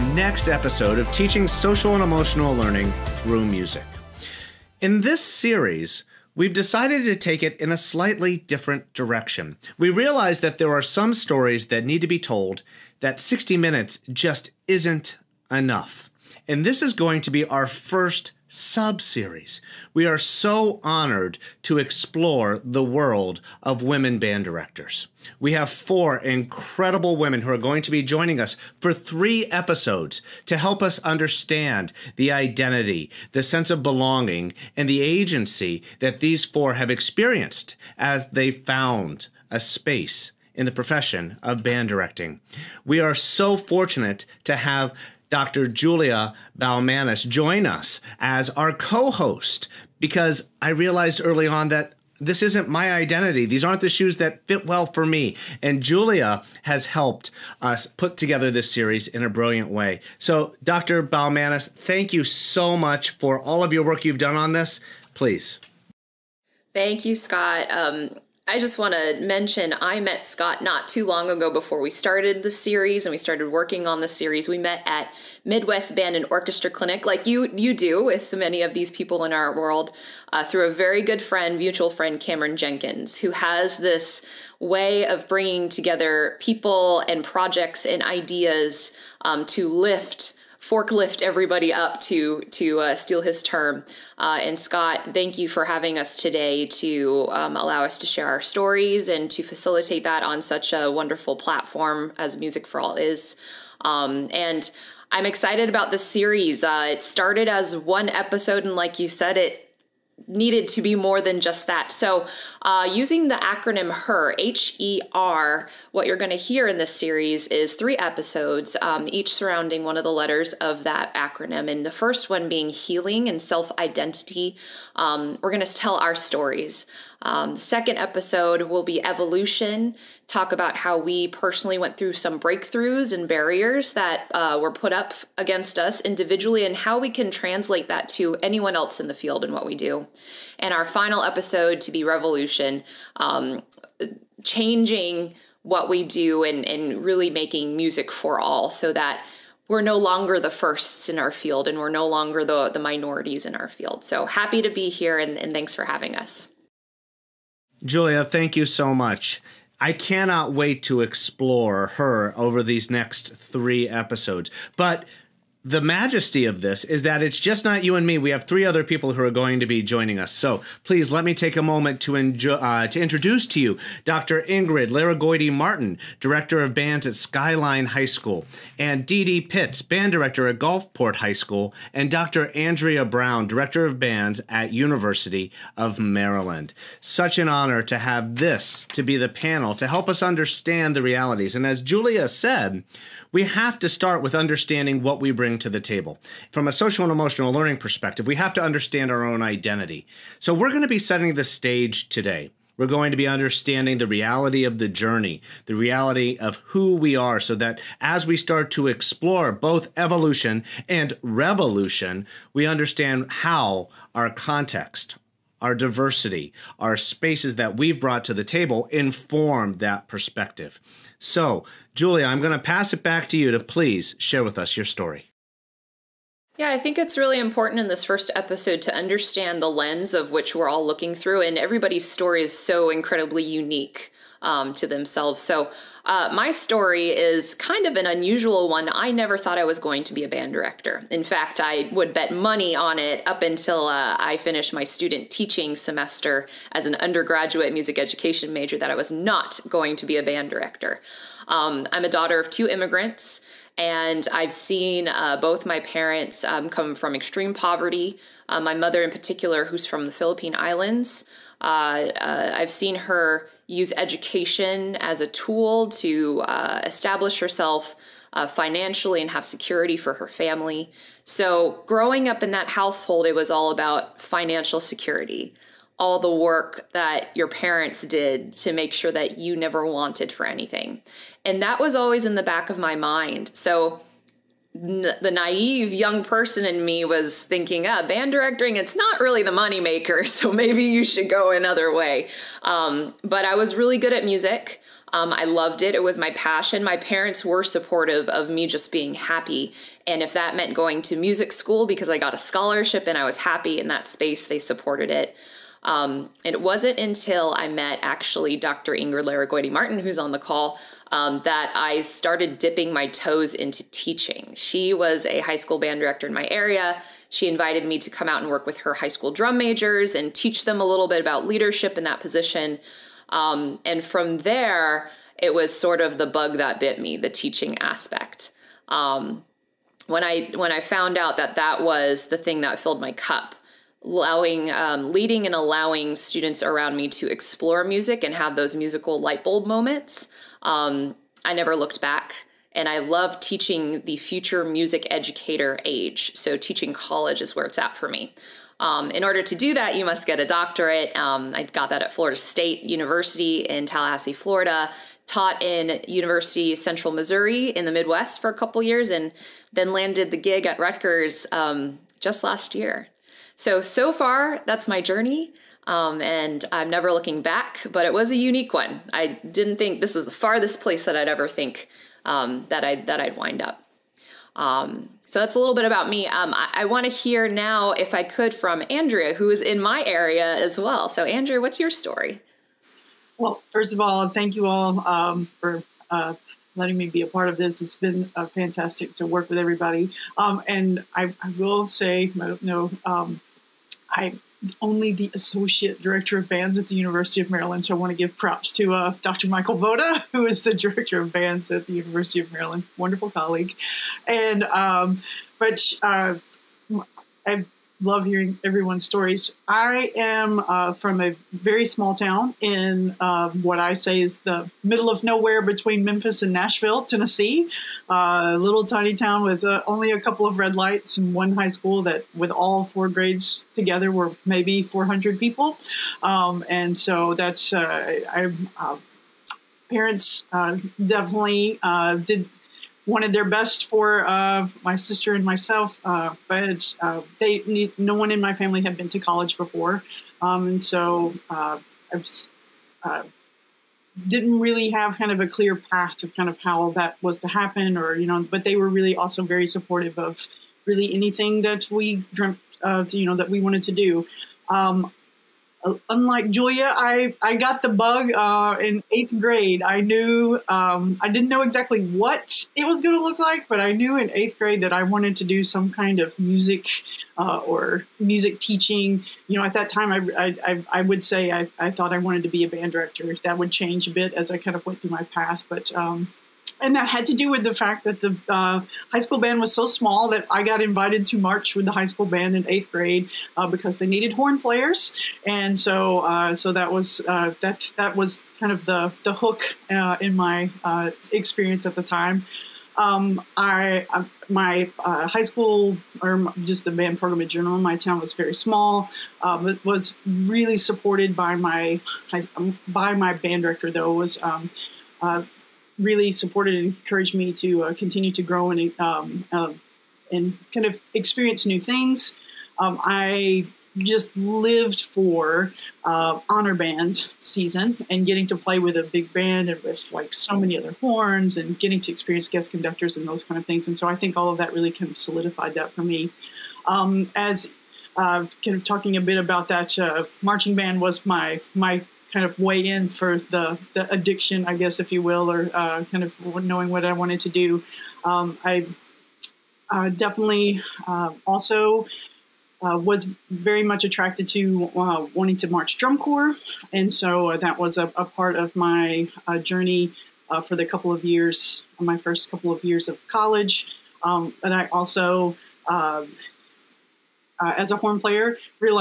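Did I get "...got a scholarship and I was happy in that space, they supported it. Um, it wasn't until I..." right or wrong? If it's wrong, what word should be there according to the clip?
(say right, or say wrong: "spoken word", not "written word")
right.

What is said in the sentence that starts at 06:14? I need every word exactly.
Um, so that's a little bit about me.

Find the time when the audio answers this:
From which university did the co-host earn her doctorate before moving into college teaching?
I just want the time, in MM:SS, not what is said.
05:52.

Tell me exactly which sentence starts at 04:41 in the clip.
And that was always in the back of my mind.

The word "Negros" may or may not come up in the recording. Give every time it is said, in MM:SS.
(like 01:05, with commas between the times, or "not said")
not said.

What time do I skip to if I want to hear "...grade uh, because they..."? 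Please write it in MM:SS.
08:02.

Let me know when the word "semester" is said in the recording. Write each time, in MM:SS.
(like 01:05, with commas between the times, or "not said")
04:05.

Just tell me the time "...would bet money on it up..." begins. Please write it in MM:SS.
04:01.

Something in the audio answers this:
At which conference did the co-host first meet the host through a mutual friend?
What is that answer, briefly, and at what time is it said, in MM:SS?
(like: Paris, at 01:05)
Midwest Band and Orchestra Clinic, at 01:15.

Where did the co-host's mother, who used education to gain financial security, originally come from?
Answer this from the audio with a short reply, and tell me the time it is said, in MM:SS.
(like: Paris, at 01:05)
Philippine Islands, at 04:20.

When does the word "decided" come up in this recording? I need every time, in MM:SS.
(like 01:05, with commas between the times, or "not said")
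00:06.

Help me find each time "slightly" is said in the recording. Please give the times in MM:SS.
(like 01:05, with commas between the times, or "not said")
00:07.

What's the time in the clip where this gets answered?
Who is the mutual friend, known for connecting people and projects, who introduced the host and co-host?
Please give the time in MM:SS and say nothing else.
01:22.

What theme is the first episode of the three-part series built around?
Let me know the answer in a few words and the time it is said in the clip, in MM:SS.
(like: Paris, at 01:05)
Healing and self identity, at 02:02.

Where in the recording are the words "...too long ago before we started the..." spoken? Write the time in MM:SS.
01:10.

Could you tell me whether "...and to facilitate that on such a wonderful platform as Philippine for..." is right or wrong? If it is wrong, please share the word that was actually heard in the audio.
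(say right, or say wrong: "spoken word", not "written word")
wrong: "Music", not "Philippine".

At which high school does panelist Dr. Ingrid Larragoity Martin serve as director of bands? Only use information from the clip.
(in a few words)
Skyline High School.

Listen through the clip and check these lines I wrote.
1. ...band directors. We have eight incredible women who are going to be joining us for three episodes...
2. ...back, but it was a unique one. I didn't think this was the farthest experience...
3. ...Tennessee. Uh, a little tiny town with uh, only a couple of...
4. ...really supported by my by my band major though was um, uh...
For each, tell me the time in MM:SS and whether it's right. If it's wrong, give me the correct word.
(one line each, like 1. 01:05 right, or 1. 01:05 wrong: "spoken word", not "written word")
1. 00:24 wrong: "four", not "eight"
2. 06:07 wrong: "place", not "experience"
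3. 06:57 right
4. 08:20 wrong: "director", not "major".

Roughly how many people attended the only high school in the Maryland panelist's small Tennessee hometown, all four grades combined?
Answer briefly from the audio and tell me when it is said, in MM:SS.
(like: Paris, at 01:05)
400, at 07:04.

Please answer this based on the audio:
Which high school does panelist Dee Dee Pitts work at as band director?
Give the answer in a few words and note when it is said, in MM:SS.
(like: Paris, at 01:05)
Gulfport High School, at 03:00.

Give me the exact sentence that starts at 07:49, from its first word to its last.
You know, at that time, I, I, I would say I, I thought I wanted to be a band director.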